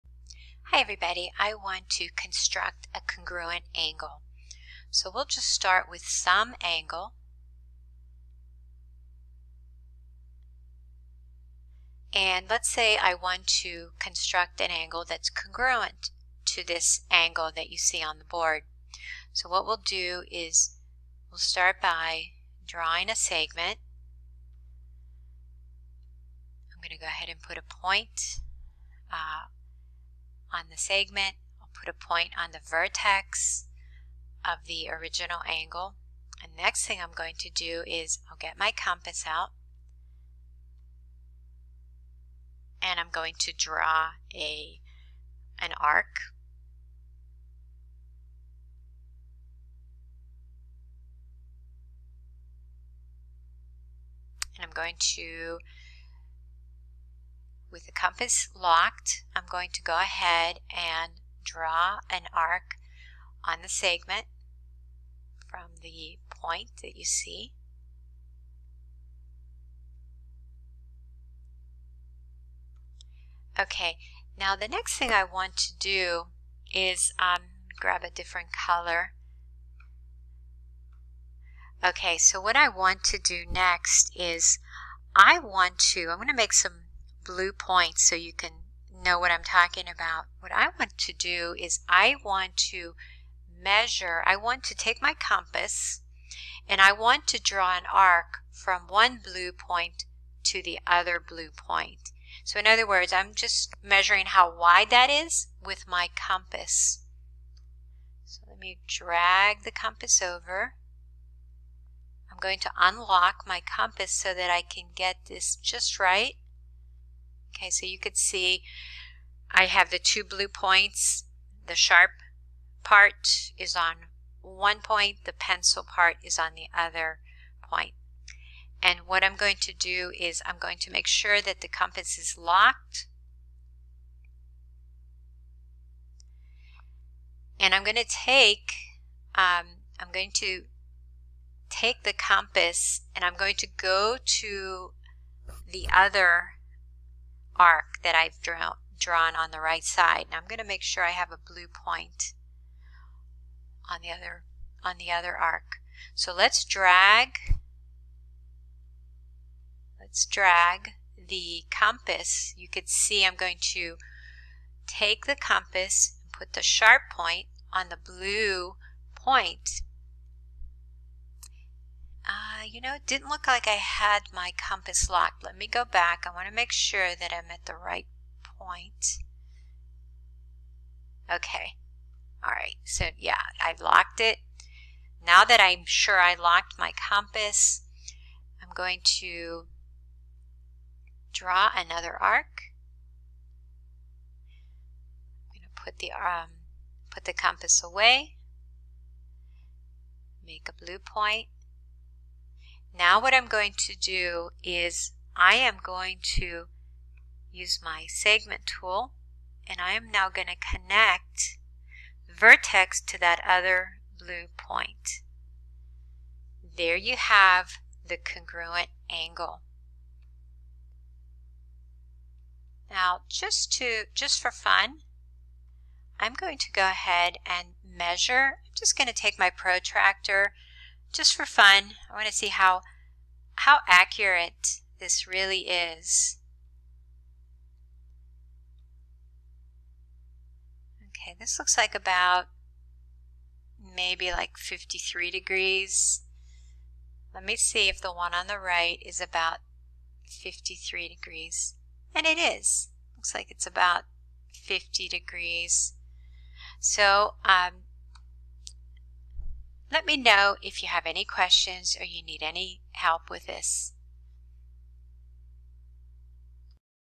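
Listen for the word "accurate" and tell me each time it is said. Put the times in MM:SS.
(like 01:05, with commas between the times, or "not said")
03:53.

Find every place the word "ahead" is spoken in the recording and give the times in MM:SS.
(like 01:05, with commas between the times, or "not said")
00:27, 00:59, 03:46.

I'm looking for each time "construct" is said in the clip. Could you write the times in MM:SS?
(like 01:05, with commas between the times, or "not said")
00:02, 00:13.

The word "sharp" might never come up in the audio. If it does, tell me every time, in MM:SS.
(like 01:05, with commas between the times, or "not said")
02:01, 02:46.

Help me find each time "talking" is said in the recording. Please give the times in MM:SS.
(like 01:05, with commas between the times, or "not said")
01:29.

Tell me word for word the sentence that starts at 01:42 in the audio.
So in other words, I'm just measuring how wide that is with my compass.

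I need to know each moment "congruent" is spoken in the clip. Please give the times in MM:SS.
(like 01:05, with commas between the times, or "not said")
00:03, 00:15, 03:38.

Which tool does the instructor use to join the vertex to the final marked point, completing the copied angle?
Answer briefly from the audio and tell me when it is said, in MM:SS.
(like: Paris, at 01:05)
Segment tool, at 03:28.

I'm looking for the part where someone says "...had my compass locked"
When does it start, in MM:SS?
02:53.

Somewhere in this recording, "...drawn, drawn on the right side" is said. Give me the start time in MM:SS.
02:28.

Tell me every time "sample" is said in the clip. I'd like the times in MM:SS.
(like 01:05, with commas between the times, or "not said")
not said.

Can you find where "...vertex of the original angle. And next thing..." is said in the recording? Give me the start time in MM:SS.
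00:32.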